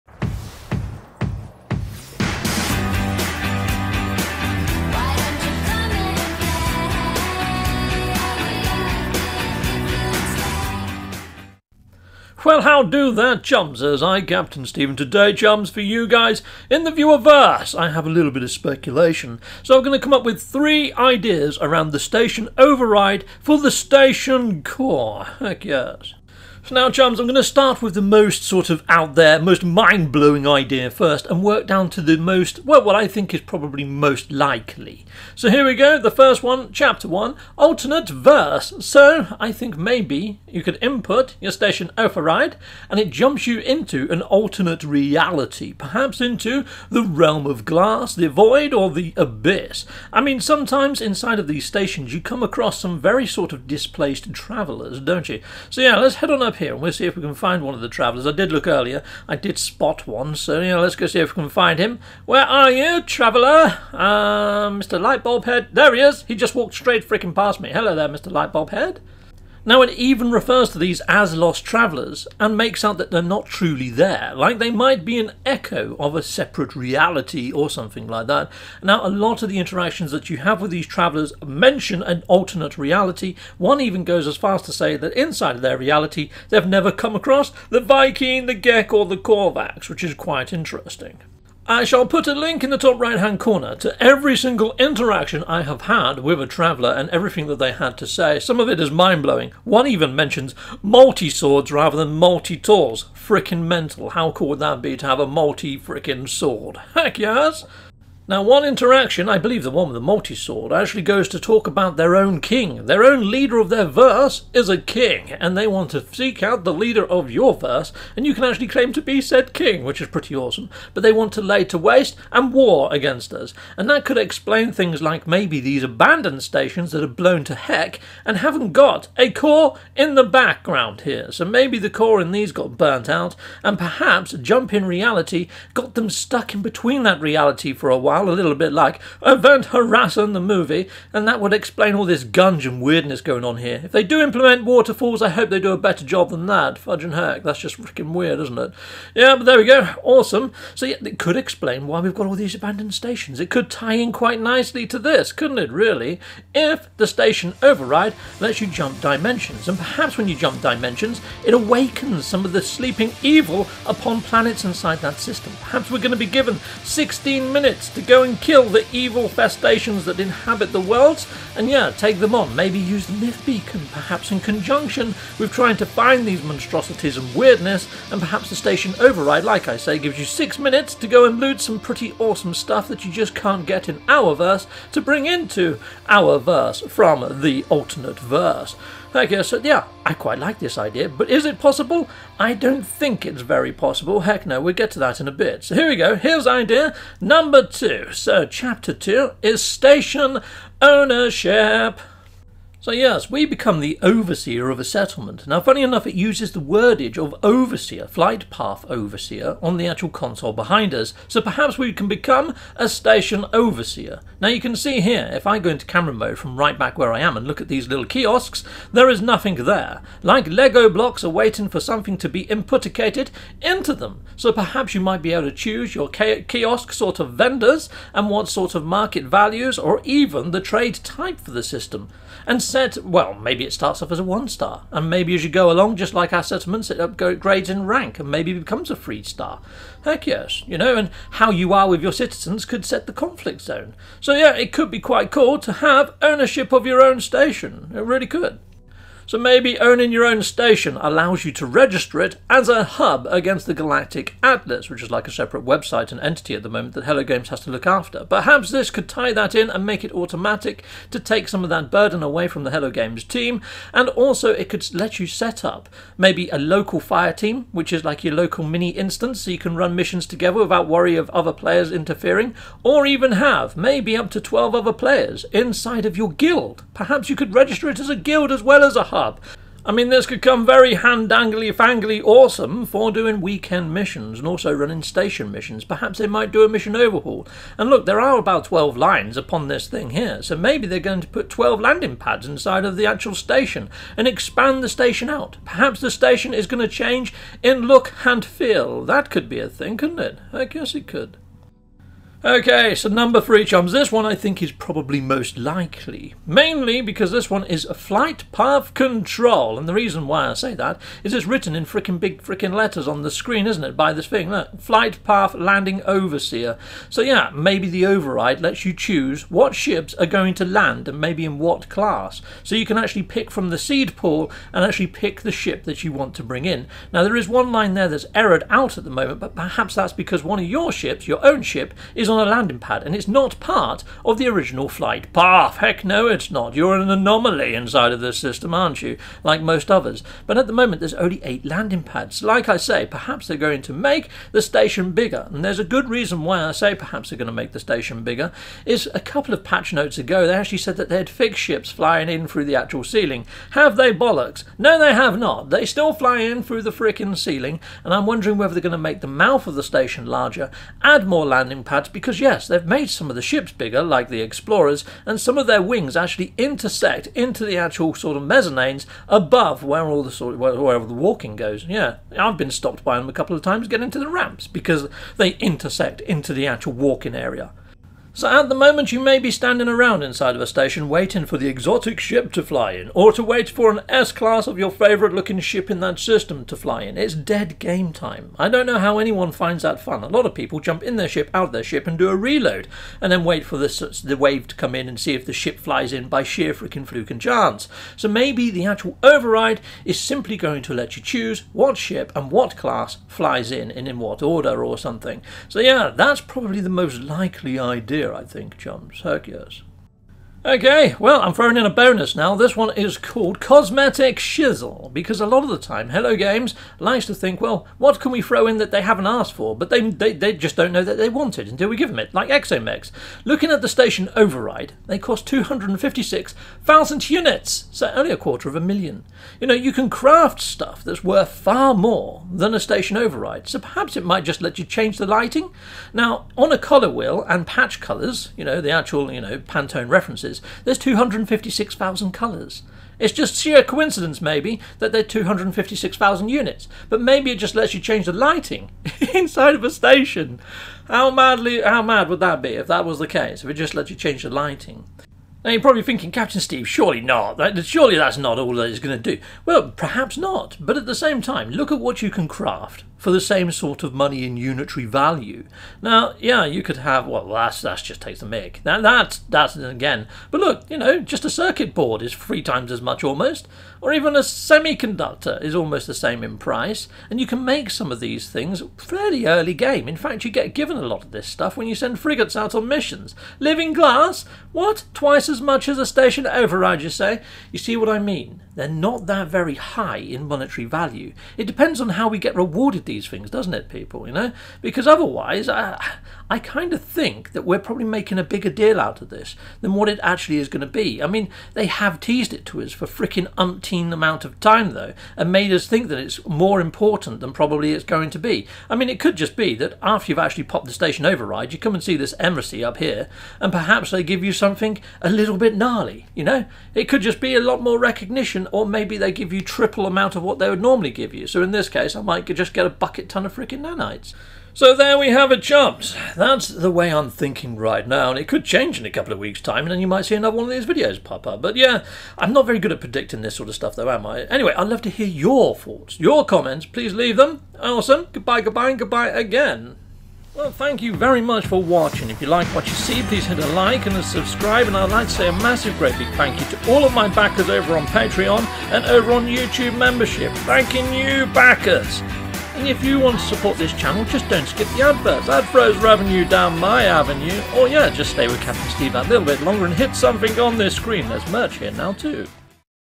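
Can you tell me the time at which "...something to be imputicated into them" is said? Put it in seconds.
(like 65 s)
221 s.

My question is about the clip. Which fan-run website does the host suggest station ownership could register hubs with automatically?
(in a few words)
Galactic Atlas.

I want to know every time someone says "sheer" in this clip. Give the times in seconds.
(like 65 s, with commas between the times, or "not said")
396 s, 443 s.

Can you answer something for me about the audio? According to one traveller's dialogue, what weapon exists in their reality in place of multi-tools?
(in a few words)
Multi swords.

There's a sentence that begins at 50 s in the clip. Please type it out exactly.
I mean, sometimes inside of these stations you come across some very sort of displaced travellers, don't you?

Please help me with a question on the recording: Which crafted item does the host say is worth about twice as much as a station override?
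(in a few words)
Living glass.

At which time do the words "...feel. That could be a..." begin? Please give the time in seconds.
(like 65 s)
298 s.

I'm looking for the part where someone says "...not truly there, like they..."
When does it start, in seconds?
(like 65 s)
73 s.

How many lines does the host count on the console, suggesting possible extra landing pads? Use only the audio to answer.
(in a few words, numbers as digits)
12.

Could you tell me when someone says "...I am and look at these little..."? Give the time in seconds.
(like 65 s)
217 s.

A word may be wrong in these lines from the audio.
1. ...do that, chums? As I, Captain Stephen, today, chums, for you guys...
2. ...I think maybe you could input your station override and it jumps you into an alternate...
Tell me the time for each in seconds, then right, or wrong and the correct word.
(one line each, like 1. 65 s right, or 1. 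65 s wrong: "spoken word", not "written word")
1. 12 s right
2. 39 s right.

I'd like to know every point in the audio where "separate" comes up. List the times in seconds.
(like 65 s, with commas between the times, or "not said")
76 s, 255 s.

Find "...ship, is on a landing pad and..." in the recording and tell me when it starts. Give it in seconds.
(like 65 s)
331 s.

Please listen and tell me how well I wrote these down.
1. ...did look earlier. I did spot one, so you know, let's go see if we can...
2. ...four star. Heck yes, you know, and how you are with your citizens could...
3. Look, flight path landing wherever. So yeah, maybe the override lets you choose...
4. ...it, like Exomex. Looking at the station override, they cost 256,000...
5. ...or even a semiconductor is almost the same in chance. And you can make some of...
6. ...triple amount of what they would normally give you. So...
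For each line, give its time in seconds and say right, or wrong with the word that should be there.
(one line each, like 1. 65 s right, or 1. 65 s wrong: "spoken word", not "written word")
1. 58 s right
2. 238 s wrong: "three", not "four"
3. 314 s wrong: "overseer", not "wherever"
4. 422 s right
5. 474 s wrong: "price", not "chance"
6. 519 s right.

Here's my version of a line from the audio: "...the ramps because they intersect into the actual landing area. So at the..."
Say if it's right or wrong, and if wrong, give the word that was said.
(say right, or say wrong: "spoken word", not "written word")
wrong: "walking", not "landing".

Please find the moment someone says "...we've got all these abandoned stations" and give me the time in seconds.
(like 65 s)
151 s.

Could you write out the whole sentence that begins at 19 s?
So I'm going to come up with three ideas around the station override for the station core.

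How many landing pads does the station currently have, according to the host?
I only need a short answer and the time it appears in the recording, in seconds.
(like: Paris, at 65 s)
8, at 341 s.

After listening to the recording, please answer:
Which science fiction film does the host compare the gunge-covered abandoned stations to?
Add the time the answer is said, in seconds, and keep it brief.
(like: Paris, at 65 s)
Event Horizon, at 139 s.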